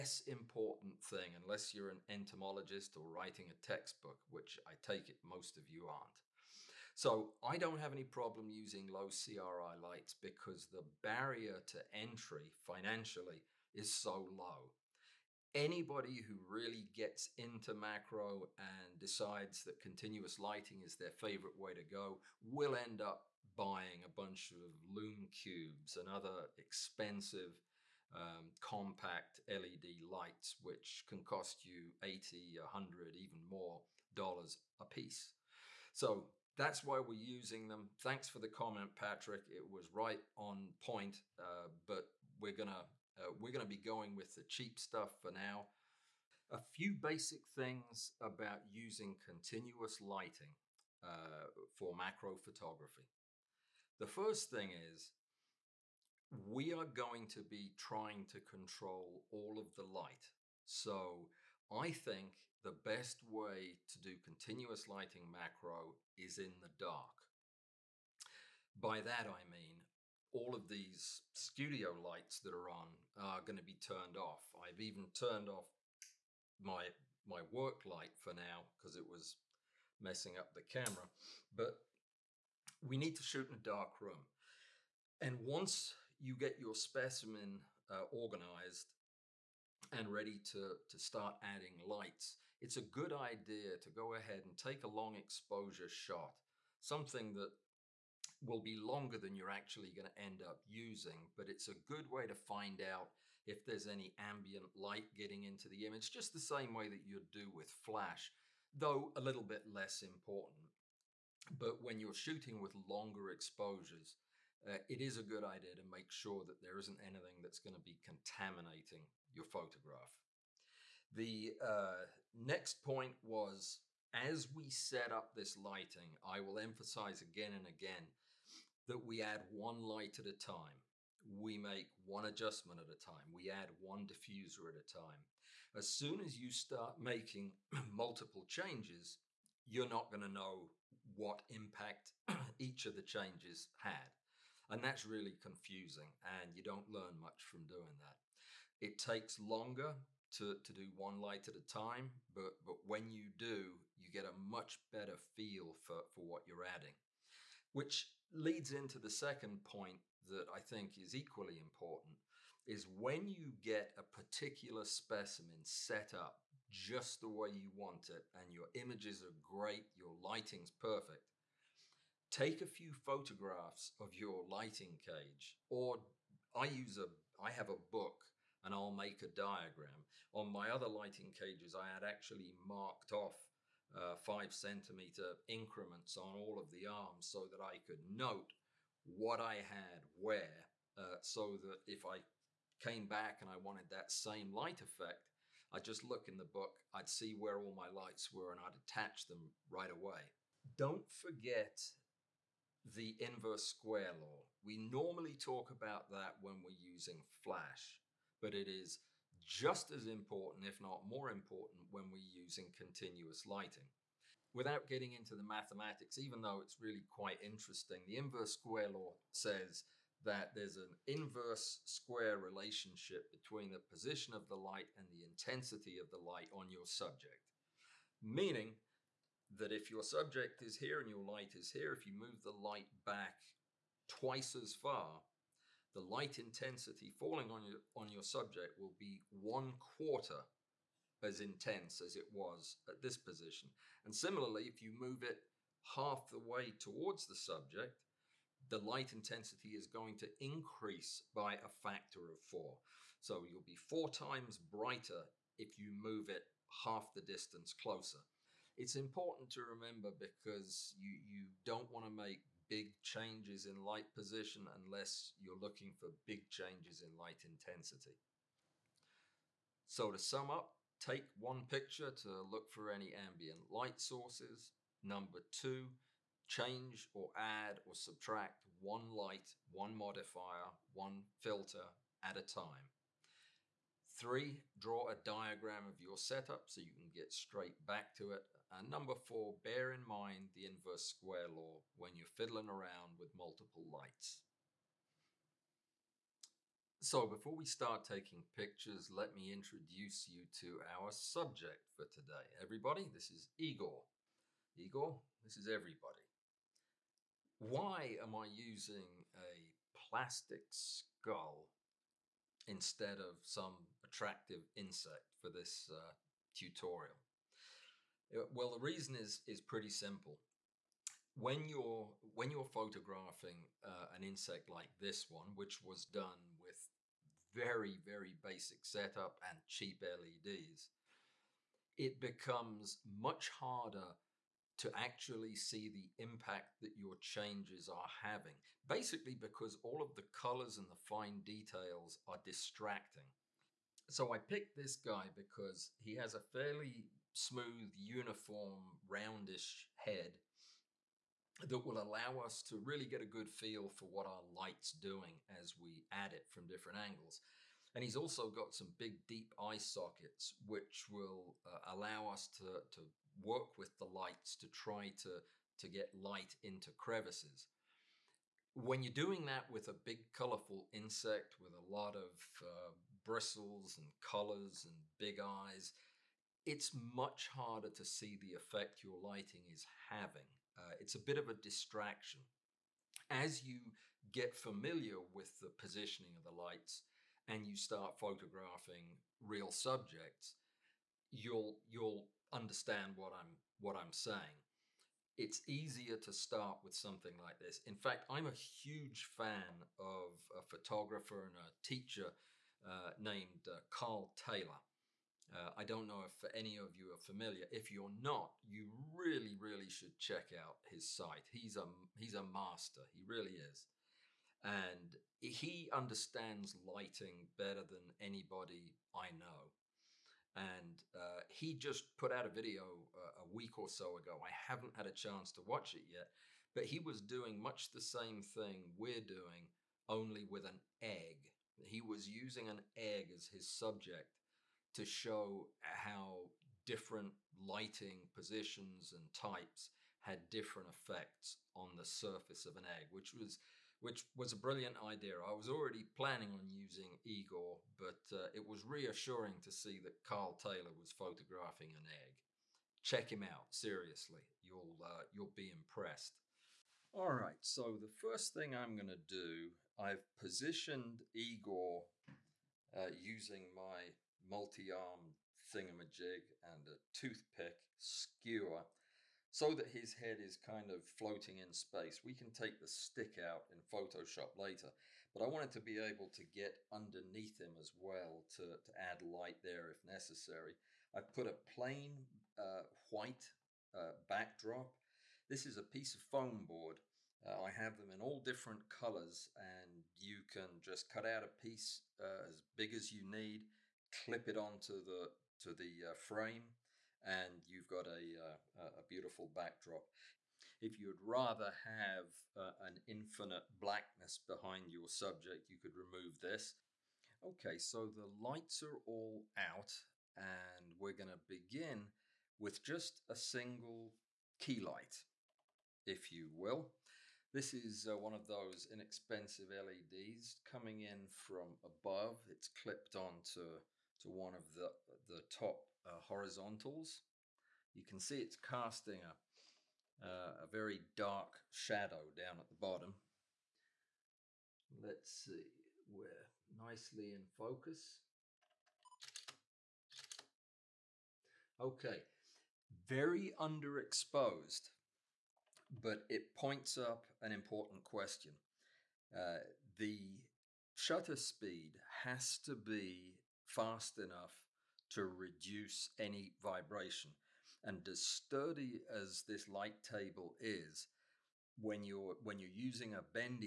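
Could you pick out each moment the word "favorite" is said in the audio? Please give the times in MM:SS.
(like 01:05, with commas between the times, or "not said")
00:21.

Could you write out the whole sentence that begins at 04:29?
So to sum up, take one picture to look for any ambient light sources.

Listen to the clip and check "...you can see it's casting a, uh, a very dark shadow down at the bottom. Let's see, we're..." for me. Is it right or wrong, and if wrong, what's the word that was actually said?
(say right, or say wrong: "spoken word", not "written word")
right.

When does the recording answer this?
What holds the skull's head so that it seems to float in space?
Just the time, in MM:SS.
07:47.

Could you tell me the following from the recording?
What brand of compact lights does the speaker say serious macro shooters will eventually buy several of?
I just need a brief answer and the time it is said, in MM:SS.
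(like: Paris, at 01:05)
Lume Cubes, at 00:24.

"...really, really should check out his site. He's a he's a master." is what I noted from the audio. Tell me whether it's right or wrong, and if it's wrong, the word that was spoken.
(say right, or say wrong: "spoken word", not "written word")
right.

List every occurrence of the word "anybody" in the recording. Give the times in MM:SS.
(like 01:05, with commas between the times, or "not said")
00:15, 06:58.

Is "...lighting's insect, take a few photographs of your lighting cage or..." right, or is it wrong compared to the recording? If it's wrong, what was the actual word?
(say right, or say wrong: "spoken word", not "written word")
wrong: "perfect", not "insect".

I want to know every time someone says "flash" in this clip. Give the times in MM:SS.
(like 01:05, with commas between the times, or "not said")
01:47, 03:27.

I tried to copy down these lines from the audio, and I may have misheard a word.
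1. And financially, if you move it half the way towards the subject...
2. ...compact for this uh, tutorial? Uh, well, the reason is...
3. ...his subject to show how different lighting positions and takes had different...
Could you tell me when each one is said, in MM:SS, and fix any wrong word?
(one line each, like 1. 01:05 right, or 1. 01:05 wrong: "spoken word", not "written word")
1. 04:04 wrong: "similarly", not "financially"
2. 05:14 wrong: "insect", not "compact"
3. 07:13 wrong: "types", not "takes".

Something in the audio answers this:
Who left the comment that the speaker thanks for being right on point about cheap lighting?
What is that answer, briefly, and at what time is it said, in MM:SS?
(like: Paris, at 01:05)
Patrick, at 00:38.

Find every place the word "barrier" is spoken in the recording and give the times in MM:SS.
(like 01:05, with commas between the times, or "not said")
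00:10.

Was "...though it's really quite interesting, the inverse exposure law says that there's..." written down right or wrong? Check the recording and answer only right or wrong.
wrong.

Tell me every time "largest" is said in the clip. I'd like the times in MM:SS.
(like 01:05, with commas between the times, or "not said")
not said.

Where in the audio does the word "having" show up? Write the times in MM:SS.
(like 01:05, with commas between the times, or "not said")
05:38, 06:20.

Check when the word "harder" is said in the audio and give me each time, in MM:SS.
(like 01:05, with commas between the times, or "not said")
05:33, 06:17.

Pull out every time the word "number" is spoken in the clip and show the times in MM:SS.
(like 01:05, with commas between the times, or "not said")
04:35, 04:48.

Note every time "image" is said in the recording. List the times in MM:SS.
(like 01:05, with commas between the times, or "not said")
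01:45, 02:48.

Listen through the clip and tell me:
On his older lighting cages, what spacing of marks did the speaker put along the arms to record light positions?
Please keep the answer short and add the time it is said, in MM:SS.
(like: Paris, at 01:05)
5 centimeters, at 03:04.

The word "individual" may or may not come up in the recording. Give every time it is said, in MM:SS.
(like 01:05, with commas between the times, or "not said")
not said.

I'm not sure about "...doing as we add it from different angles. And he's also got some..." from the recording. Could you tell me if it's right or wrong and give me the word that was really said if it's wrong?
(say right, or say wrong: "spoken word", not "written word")
right.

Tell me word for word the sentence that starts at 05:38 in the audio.
Basically, because all of the colors and the fine details are distracting.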